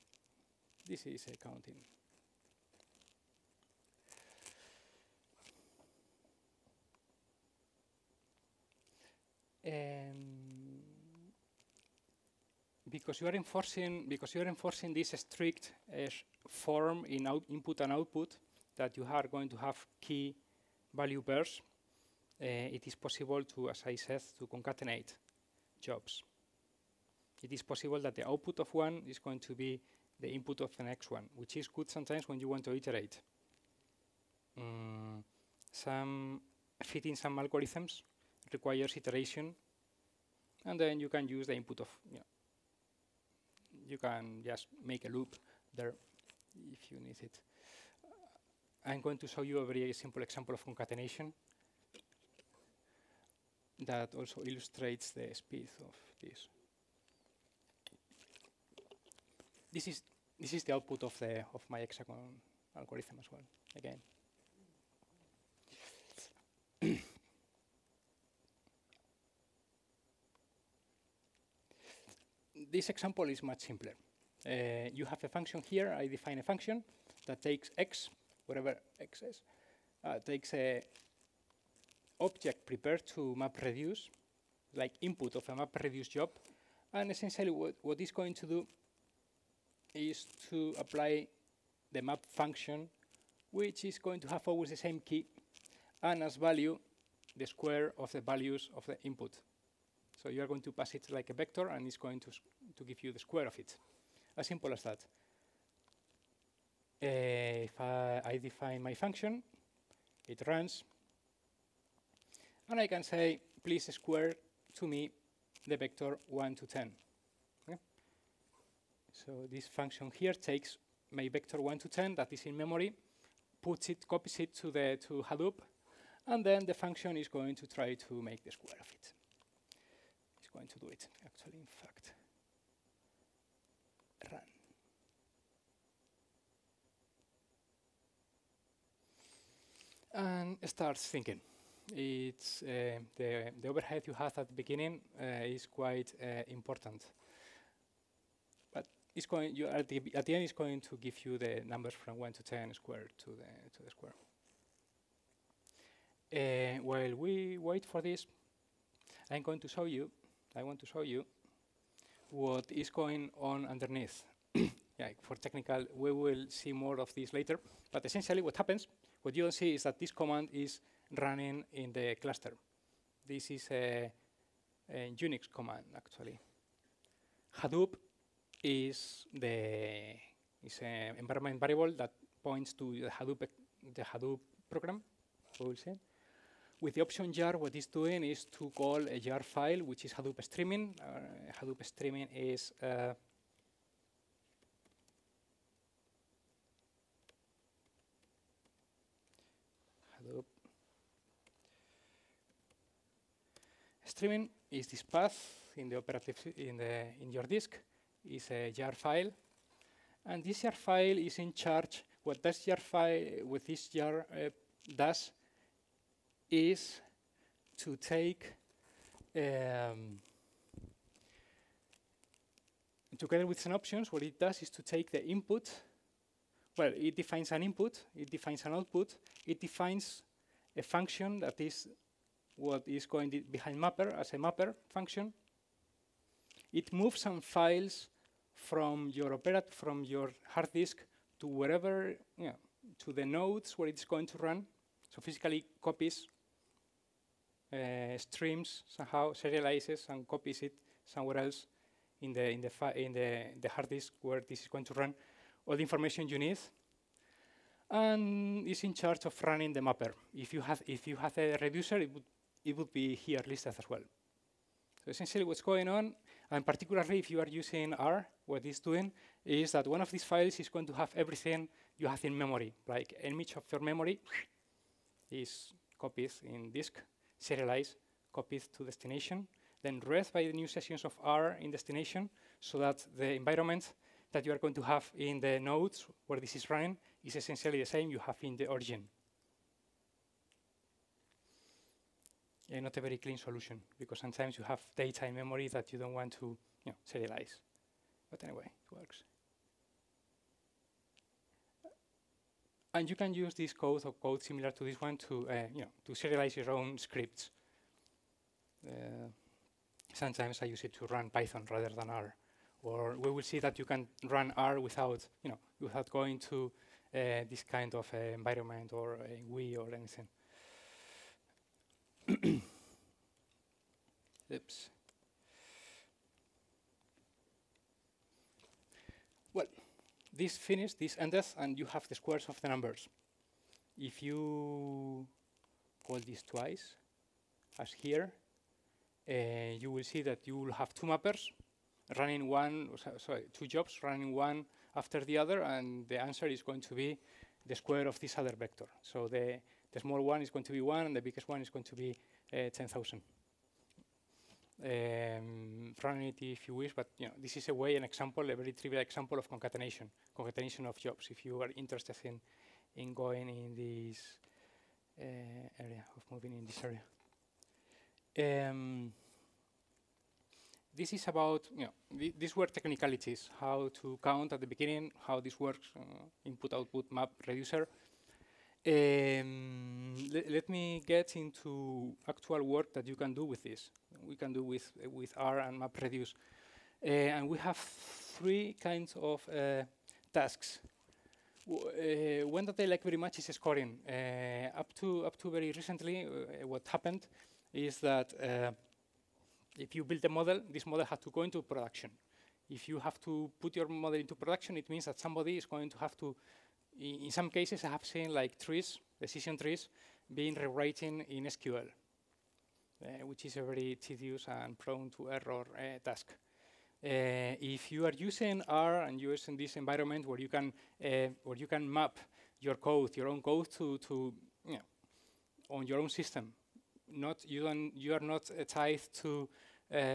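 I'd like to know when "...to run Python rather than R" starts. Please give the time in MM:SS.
05:10.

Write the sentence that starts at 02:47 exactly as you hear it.
But essentially what happens, what you don't see is that this command is running in the cluster.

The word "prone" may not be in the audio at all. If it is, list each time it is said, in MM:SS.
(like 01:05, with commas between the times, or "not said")
06:54.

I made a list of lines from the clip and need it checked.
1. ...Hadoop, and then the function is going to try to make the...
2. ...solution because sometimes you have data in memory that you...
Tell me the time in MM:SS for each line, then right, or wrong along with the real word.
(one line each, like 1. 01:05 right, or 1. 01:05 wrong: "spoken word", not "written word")
1. 02:05 right
2. 04:53 right.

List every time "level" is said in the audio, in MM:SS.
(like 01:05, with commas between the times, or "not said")
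not said.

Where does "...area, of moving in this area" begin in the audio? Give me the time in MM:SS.
06:05.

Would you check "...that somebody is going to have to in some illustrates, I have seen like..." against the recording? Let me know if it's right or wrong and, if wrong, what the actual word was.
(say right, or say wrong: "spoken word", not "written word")
wrong: "cases", not "illustrates".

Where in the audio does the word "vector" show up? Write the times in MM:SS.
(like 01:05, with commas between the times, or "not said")
01:41, 01:55, 02:01, 05:48.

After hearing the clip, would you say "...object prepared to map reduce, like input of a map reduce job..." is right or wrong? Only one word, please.
right.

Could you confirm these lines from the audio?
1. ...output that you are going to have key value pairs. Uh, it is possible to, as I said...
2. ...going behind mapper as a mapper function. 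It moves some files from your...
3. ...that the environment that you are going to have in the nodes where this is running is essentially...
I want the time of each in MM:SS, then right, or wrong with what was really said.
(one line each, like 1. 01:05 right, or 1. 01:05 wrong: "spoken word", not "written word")
1. 00:17 right
2. 03:53 right
3. 04:42 right.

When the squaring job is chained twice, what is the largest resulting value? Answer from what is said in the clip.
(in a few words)
10,000.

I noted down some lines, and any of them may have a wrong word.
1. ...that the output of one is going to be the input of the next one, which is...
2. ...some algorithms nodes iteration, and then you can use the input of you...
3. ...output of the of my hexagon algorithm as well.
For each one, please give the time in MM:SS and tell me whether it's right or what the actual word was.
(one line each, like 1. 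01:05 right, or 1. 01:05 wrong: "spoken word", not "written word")
1. 00:27 right
2. 00:37 wrong: "requires", not "nodes"
3. 01:00 right.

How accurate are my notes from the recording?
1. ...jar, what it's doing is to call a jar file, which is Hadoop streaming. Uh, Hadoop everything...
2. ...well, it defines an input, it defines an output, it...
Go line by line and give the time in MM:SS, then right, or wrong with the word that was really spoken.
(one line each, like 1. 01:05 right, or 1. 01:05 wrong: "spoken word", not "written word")
1. 03:07 wrong: "streaming", not "everything"
2. 03:46 right.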